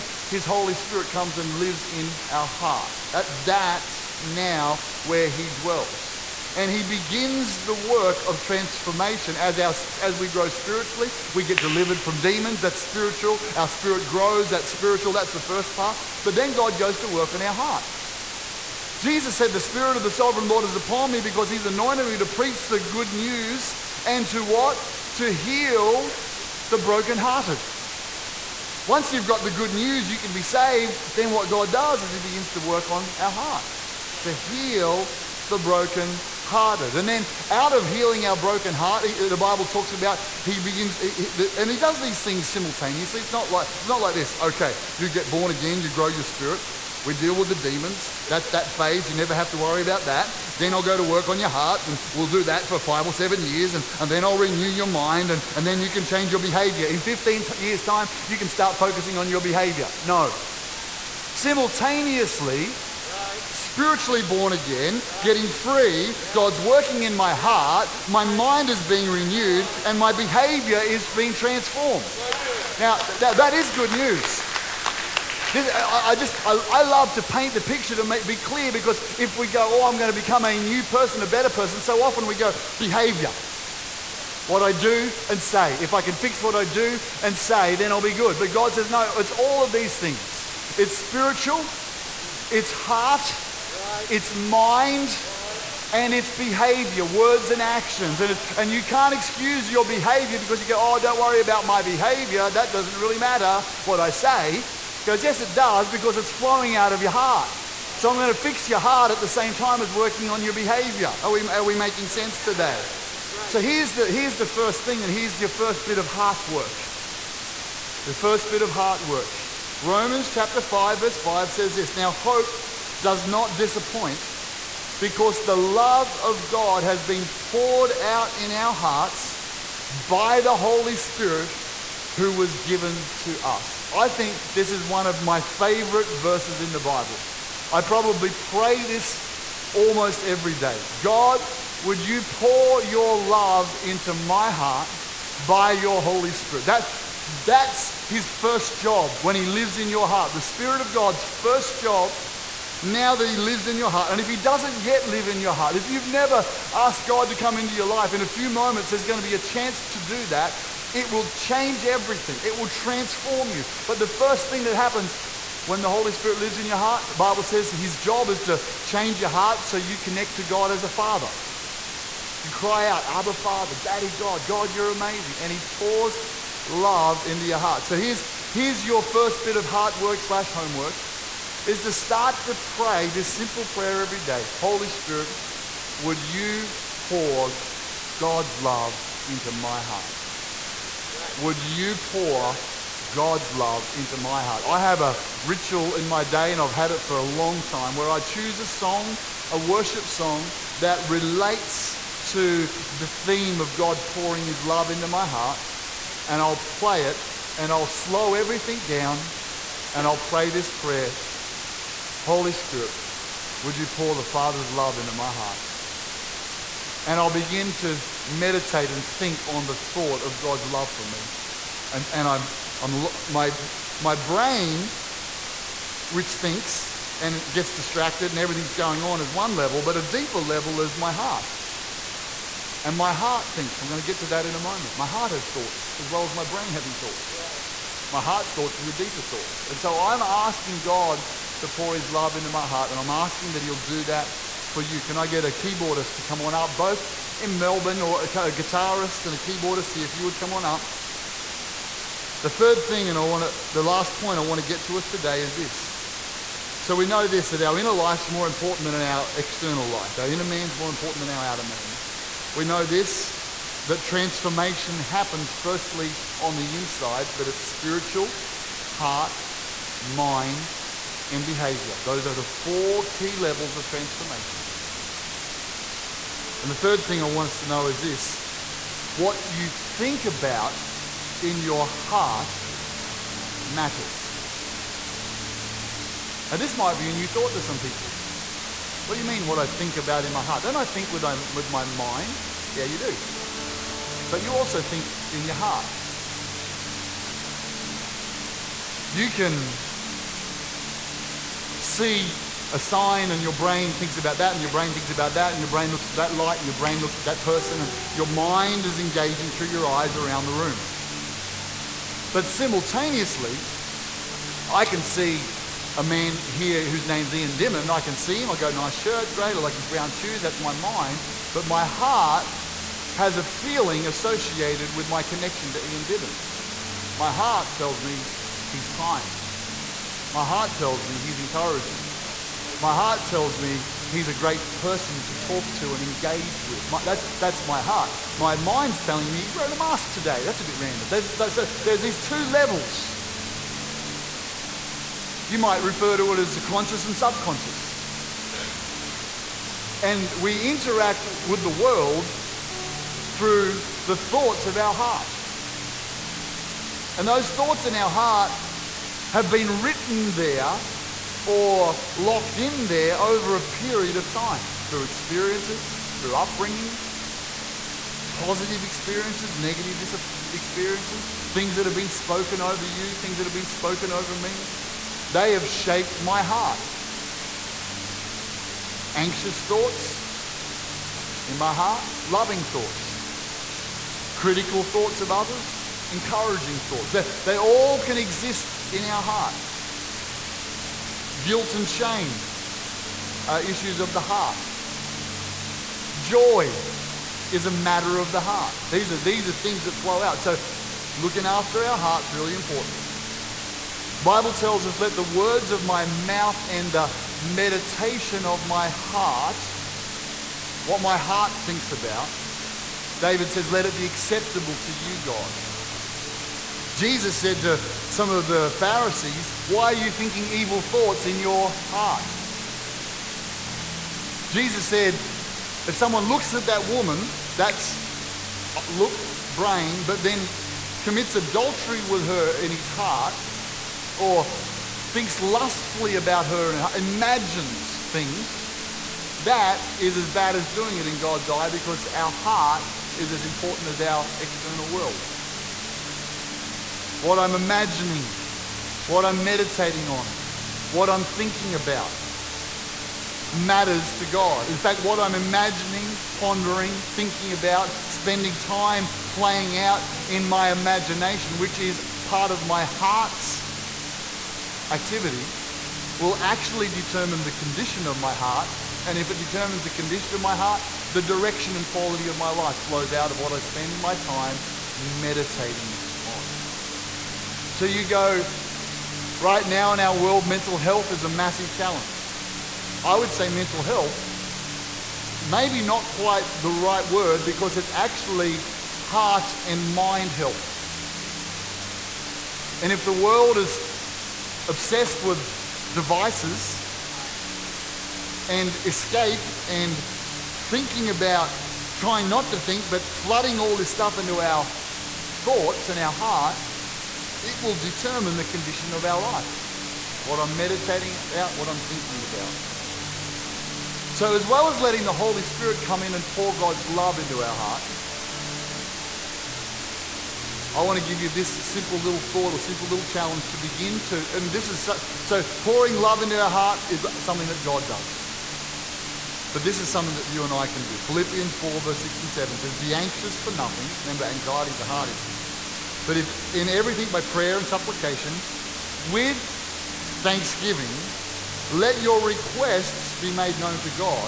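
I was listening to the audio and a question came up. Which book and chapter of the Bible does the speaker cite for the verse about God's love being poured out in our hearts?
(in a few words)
Romans chapter 5.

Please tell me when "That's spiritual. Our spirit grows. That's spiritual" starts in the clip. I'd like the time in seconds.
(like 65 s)
12 s.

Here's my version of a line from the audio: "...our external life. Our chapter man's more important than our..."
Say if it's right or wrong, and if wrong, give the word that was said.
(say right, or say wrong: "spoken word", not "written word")
wrong: "inner", not "chapter".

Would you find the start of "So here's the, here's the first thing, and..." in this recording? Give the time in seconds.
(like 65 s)
113 s.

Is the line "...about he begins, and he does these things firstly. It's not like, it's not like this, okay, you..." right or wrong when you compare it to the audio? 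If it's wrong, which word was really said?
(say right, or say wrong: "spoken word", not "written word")
wrong: "simultaneously", not "firstly".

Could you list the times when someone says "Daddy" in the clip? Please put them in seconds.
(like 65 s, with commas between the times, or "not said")
173 s.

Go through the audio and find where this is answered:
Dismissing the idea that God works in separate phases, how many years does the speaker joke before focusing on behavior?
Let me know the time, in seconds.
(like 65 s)
57 s.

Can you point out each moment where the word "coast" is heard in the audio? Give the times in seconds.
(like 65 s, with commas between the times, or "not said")
not said.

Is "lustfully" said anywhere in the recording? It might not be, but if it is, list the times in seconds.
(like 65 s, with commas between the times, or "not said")
435 s.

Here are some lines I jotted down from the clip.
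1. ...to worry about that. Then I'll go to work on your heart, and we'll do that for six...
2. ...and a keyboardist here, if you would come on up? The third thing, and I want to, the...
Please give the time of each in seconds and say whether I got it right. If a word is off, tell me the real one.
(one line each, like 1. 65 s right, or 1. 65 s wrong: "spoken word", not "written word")
1. 49 s wrong: "five", not "six"
2. 249 s right.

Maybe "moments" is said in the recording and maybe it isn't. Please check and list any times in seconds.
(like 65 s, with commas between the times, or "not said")
158 s, 234 s.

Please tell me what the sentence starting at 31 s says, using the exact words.
Then what God does is He begins to work on our heart to heal the broken hearted.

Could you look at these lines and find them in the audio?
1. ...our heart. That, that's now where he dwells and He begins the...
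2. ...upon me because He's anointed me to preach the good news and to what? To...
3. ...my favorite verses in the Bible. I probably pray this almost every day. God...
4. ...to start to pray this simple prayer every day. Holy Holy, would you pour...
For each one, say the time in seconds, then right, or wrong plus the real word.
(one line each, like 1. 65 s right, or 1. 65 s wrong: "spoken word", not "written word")
1. 2 s right
2. 20 s right
3. 135 s right
4. 181 s wrong: "Spirit", not "Holy".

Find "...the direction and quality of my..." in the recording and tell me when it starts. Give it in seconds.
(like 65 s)
471 s.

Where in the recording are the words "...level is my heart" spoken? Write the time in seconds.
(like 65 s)
230 s.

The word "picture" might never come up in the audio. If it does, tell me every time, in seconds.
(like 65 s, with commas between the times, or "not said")
77 s.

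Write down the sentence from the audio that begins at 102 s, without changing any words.
That doesn't really matter what I say.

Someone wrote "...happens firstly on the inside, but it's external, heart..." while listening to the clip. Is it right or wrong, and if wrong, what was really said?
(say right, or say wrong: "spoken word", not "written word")
wrong: "spiritual", not "external".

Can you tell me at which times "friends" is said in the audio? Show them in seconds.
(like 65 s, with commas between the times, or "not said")
not said.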